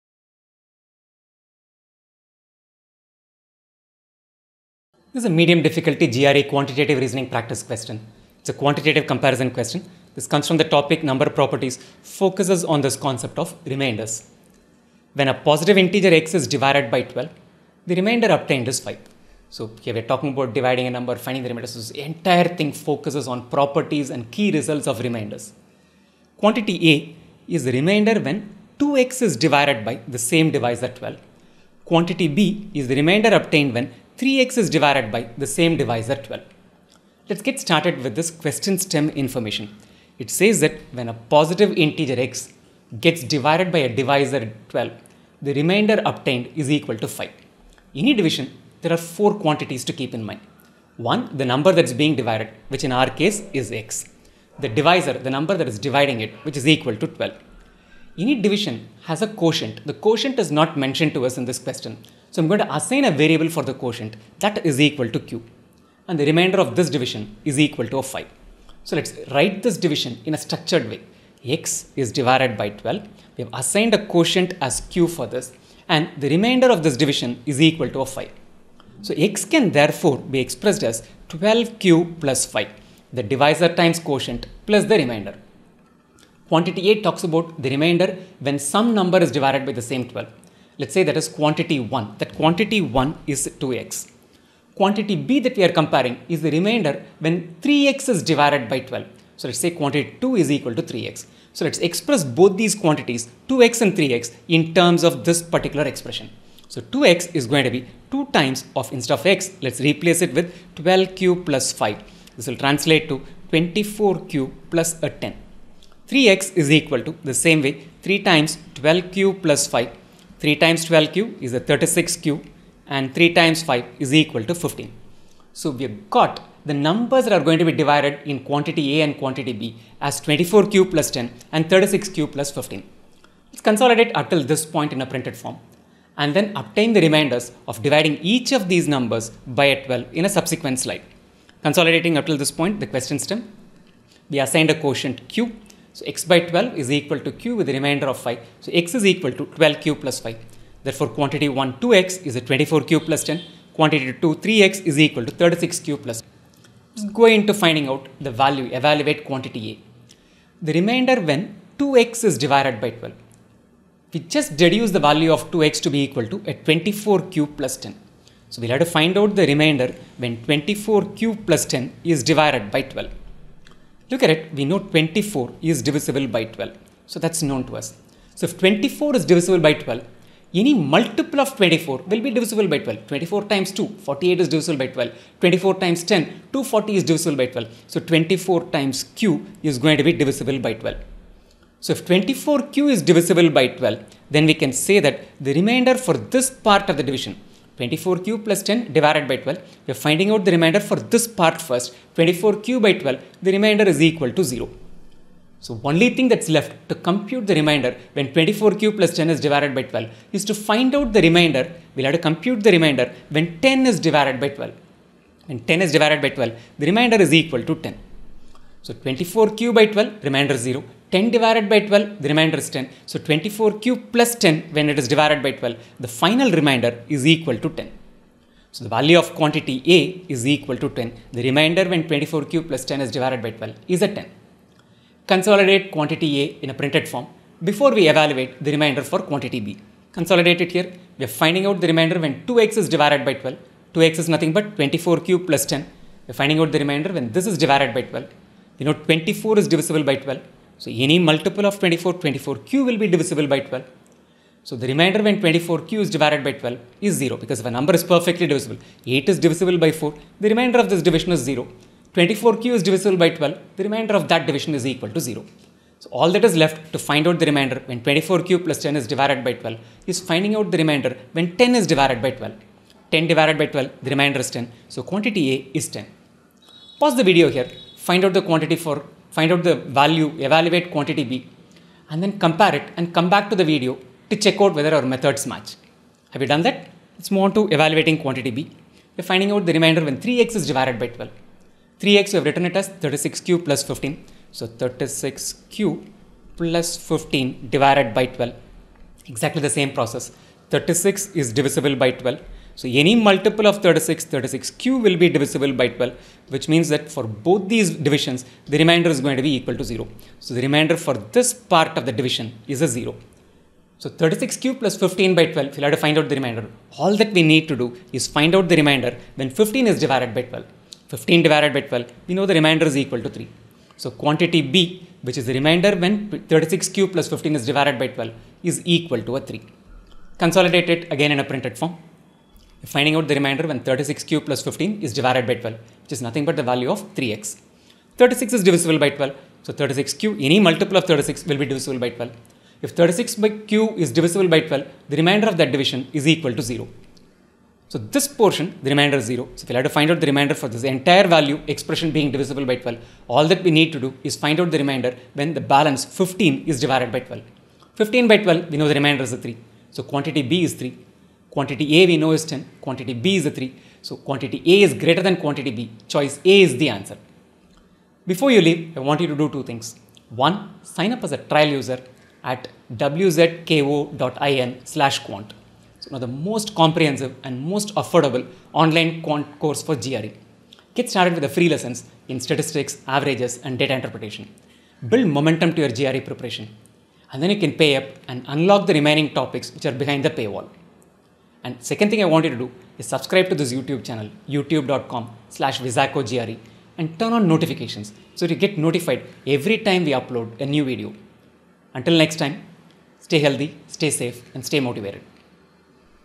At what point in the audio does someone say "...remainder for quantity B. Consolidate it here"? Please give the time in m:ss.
3:58.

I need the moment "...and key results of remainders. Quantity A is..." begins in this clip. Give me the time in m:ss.
0:24.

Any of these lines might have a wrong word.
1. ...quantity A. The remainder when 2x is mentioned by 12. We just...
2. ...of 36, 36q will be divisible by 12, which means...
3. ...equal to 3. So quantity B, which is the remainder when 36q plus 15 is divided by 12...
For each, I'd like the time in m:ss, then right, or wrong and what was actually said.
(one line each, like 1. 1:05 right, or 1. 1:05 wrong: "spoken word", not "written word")
1. 2:39 wrong: "divided", not "mentioned"
2. 5:03 right
3. 5:22 right.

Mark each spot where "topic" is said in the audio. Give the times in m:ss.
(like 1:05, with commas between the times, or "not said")
0:10, 6:29.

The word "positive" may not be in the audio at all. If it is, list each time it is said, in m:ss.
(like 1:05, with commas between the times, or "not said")
0:15, 0:41.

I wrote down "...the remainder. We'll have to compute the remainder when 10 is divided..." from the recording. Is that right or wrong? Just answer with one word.
right.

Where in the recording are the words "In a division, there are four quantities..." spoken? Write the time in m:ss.
0:47.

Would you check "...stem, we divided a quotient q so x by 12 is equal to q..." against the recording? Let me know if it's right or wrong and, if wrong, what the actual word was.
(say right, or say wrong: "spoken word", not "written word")
wrong: "assigned", not "divided".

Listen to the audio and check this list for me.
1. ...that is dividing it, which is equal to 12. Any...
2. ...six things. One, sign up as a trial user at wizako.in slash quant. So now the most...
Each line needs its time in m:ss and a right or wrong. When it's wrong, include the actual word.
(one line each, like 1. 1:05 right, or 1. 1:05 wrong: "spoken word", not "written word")
1. 0:55 right
2. 6:09 wrong: "two", not "six".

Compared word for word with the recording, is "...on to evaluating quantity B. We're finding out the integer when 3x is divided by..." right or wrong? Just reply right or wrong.
wrong.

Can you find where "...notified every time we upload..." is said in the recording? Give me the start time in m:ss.
6:38.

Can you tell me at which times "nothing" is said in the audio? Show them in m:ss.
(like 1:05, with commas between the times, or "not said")
4:04, 5:36.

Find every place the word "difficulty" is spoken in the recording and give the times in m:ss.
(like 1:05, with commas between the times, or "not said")
0:05.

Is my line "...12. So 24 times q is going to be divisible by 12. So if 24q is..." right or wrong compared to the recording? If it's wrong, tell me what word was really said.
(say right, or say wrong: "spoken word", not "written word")
right.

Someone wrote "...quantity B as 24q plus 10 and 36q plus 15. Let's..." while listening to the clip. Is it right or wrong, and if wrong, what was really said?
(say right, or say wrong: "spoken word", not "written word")
right.